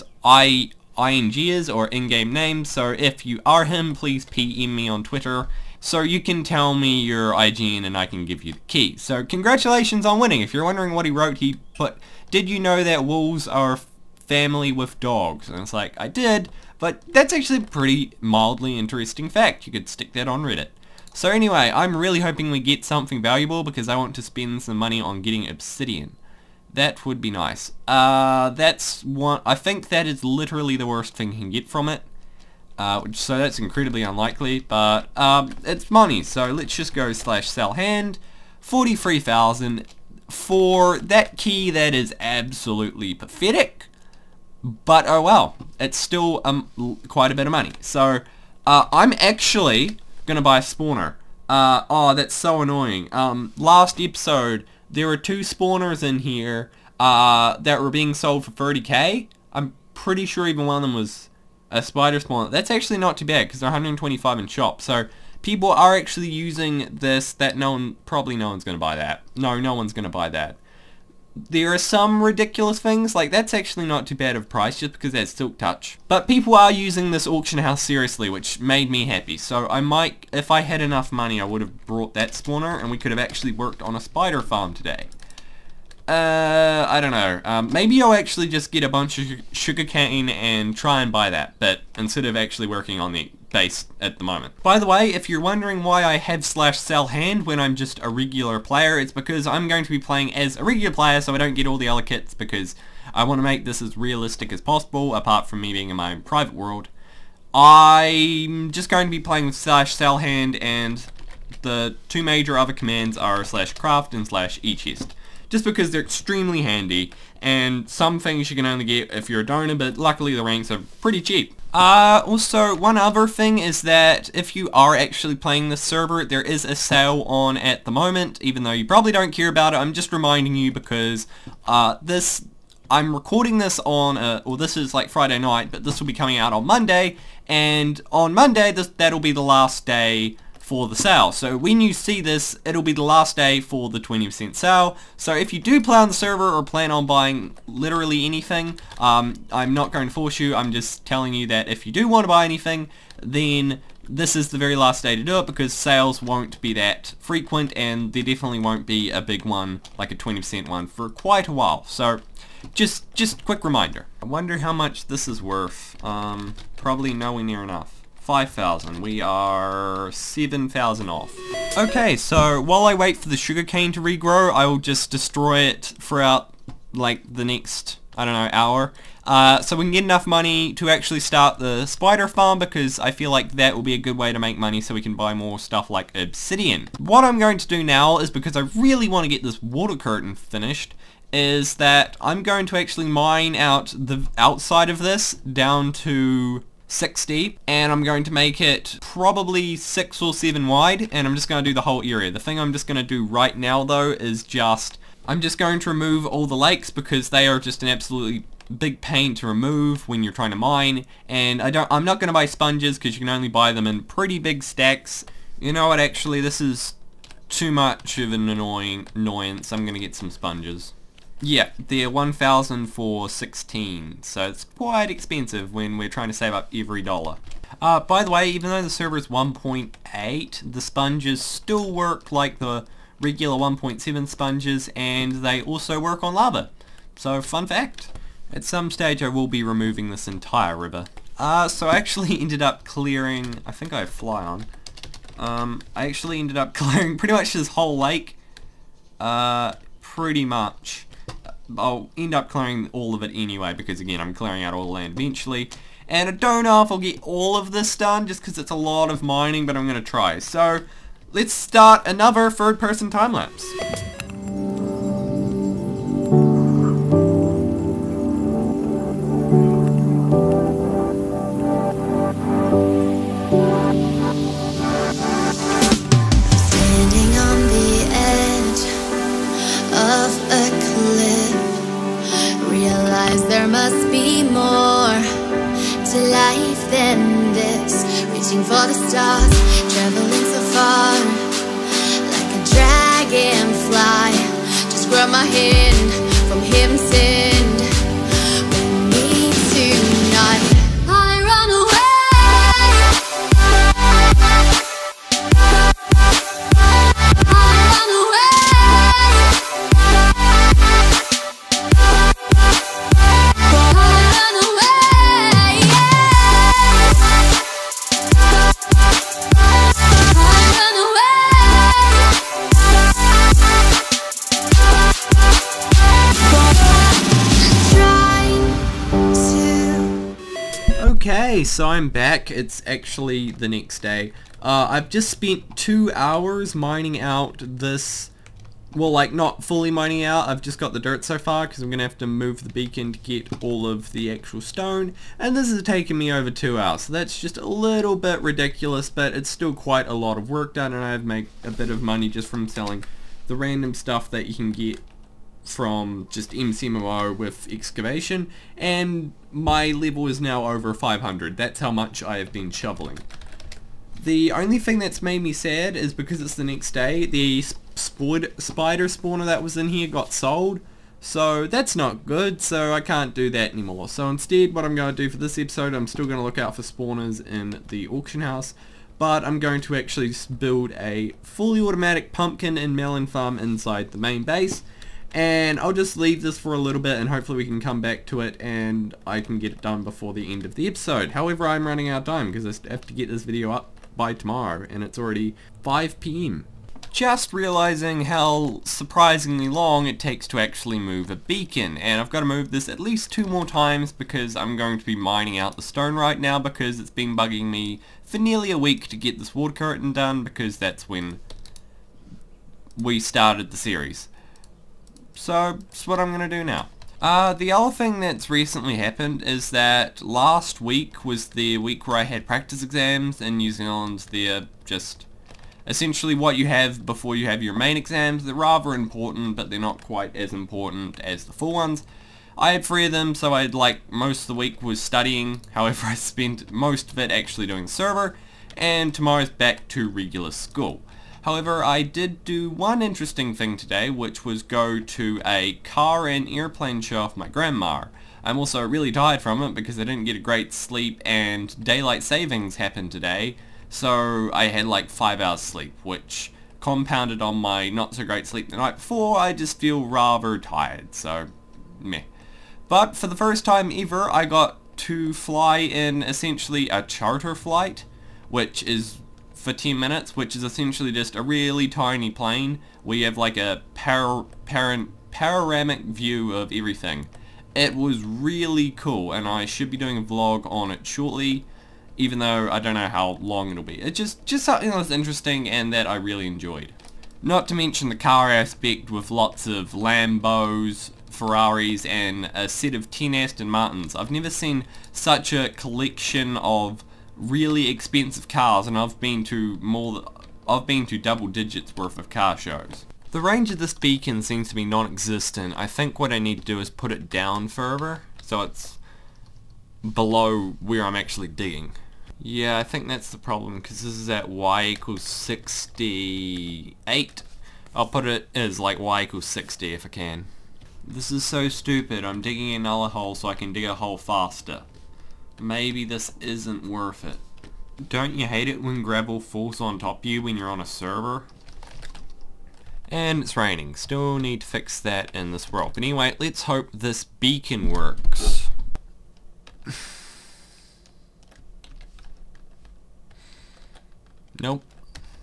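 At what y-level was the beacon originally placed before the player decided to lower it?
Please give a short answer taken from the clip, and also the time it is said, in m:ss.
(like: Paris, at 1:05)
68, at 8:34.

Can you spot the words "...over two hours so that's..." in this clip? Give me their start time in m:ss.
5:46.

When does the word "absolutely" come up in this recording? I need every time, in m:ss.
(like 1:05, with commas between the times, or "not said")
0:42, 3:27.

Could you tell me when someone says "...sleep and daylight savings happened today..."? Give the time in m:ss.
7:30.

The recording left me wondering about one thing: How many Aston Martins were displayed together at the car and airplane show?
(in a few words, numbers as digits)
10.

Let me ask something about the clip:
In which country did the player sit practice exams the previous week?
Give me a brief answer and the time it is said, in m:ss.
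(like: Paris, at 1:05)
New Zealand, at 7:03.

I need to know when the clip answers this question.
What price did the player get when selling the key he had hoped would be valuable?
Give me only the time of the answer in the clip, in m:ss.
0:38.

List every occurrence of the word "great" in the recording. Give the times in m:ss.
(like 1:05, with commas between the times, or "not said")
7:30, 7:38.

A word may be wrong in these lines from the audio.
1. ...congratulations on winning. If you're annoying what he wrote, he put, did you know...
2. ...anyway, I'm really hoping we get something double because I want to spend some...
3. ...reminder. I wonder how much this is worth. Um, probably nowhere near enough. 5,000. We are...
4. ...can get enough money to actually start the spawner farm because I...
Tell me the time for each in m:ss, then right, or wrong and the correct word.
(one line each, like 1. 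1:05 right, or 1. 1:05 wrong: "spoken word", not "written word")
1. 0:09 wrong: "wondering", not "annoying"
2. 0:21 wrong: "valuable", not "double"
3. 2:43 right
4. 2:59 wrong: "spider", not "spawner".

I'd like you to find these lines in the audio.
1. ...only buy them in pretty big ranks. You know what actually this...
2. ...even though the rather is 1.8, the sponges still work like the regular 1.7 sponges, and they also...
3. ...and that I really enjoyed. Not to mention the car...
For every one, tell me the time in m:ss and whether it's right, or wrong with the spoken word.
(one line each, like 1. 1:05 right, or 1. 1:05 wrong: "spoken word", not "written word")
1. 3:33 wrong: "stacks", not "ranks"
2. 3:48 wrong: "server", not "rather"
3. 8:05 right.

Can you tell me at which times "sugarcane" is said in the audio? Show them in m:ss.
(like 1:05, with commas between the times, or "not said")
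1:29, 2:53.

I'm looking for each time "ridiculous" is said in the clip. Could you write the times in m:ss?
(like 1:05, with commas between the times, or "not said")
1:12, 5:48.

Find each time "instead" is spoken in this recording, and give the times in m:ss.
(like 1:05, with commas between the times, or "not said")
1:31, 6:14.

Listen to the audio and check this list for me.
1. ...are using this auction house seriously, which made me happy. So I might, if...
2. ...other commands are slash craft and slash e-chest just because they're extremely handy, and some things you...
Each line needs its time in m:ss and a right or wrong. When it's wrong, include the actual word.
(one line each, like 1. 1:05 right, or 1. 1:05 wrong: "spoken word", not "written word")
1. 1:16 right
2. 1:52 right.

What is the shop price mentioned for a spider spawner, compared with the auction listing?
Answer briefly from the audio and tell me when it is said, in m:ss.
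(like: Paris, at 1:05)
125, at 1:03.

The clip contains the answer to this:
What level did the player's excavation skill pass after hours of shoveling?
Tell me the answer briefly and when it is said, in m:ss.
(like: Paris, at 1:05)
over 500, at 6:00.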